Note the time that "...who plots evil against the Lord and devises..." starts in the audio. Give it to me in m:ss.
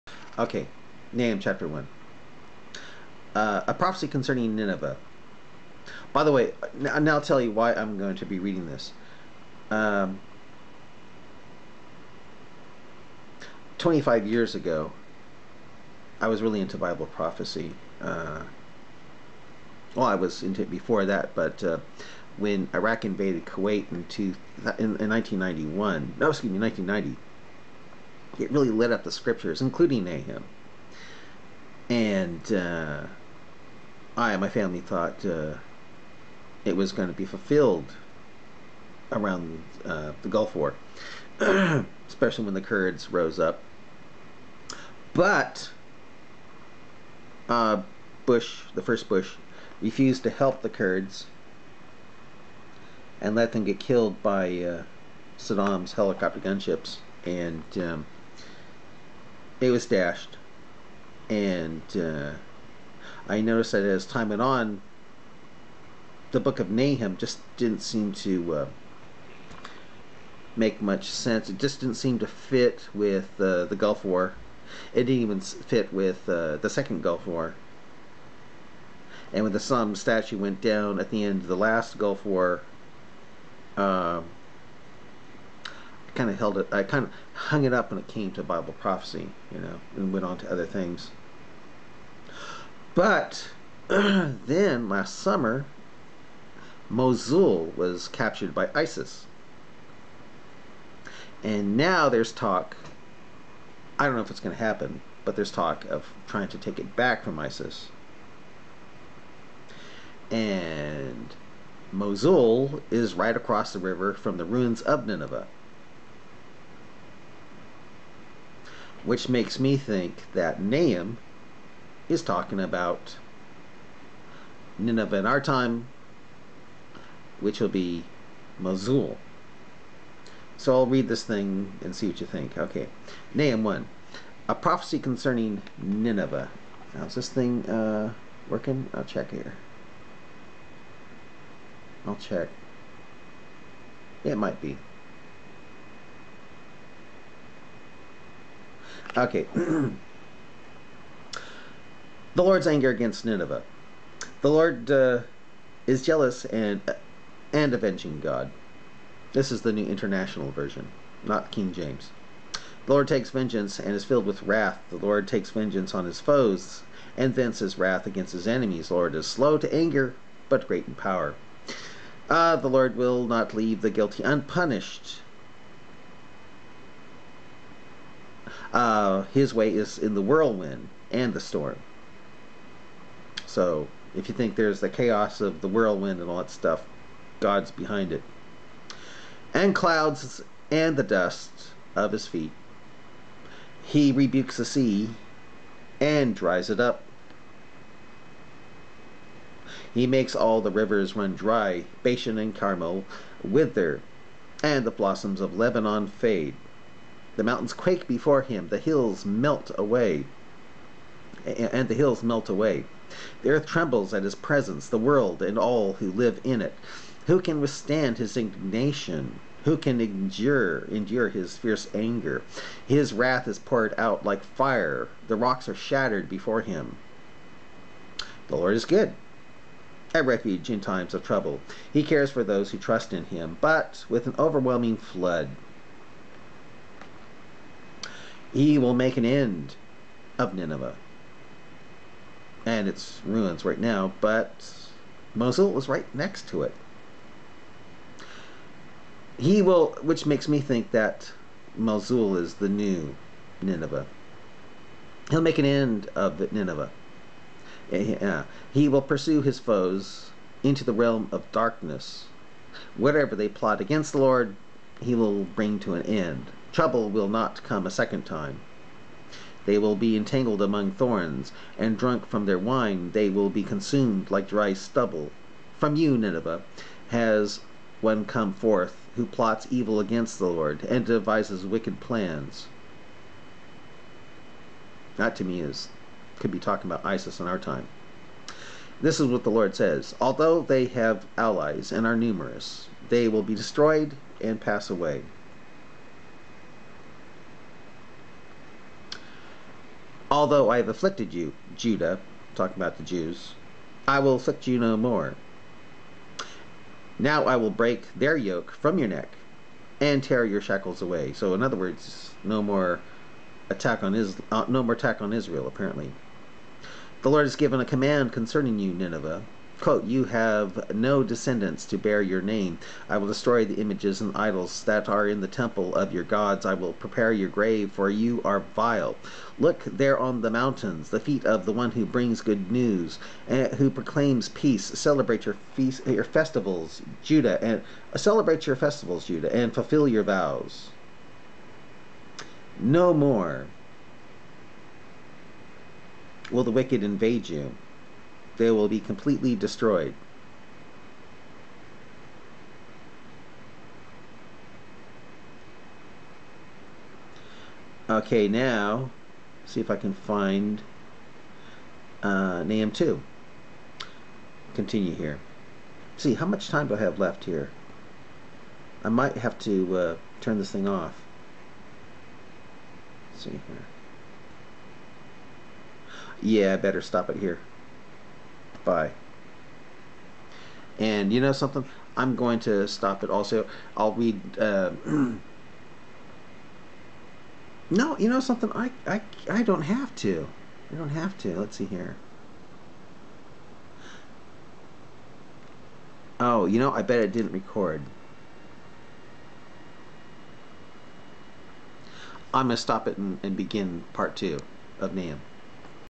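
4:39.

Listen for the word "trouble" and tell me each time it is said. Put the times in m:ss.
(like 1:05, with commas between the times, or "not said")
3:51, 4:26.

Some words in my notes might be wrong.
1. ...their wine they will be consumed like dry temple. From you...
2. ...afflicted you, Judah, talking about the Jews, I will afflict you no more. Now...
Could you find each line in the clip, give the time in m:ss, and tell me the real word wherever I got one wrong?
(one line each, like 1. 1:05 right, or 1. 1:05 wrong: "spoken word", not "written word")
1. 4:32 wrong: "stubble", not "temple"
2. 5:00 right.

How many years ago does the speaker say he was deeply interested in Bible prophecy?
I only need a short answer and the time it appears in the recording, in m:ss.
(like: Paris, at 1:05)
25, at 0:13.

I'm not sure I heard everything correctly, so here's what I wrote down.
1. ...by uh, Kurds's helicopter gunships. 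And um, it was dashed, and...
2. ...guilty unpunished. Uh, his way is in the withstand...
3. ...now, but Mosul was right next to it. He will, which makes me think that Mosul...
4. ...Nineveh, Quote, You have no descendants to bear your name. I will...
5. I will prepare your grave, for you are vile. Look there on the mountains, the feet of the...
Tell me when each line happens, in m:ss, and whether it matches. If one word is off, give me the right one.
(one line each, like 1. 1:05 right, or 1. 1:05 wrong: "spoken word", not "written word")
1. 0:54 wrong: "Saddam", not "Kurds"
2. 2:53 wrong: "whirlwind", not "withstand"
3. 4:03 right
4. 5:18 right
5. 5:26 right.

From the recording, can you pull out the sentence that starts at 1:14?
It didn't even fit with uh, the Second Gulf War.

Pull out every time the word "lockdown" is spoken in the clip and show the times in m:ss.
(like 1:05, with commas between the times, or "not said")
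not said.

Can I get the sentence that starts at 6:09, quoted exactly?
I might have to uh, turn this thing off.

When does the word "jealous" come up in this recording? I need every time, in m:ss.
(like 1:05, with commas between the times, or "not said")
2:36.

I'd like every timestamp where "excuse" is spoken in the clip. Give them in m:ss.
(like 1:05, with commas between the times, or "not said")
0:26.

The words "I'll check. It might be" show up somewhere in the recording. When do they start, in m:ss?
2:22.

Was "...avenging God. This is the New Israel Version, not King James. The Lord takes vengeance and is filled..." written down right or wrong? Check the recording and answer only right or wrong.
wrong.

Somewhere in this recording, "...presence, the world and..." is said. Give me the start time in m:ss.
3:34.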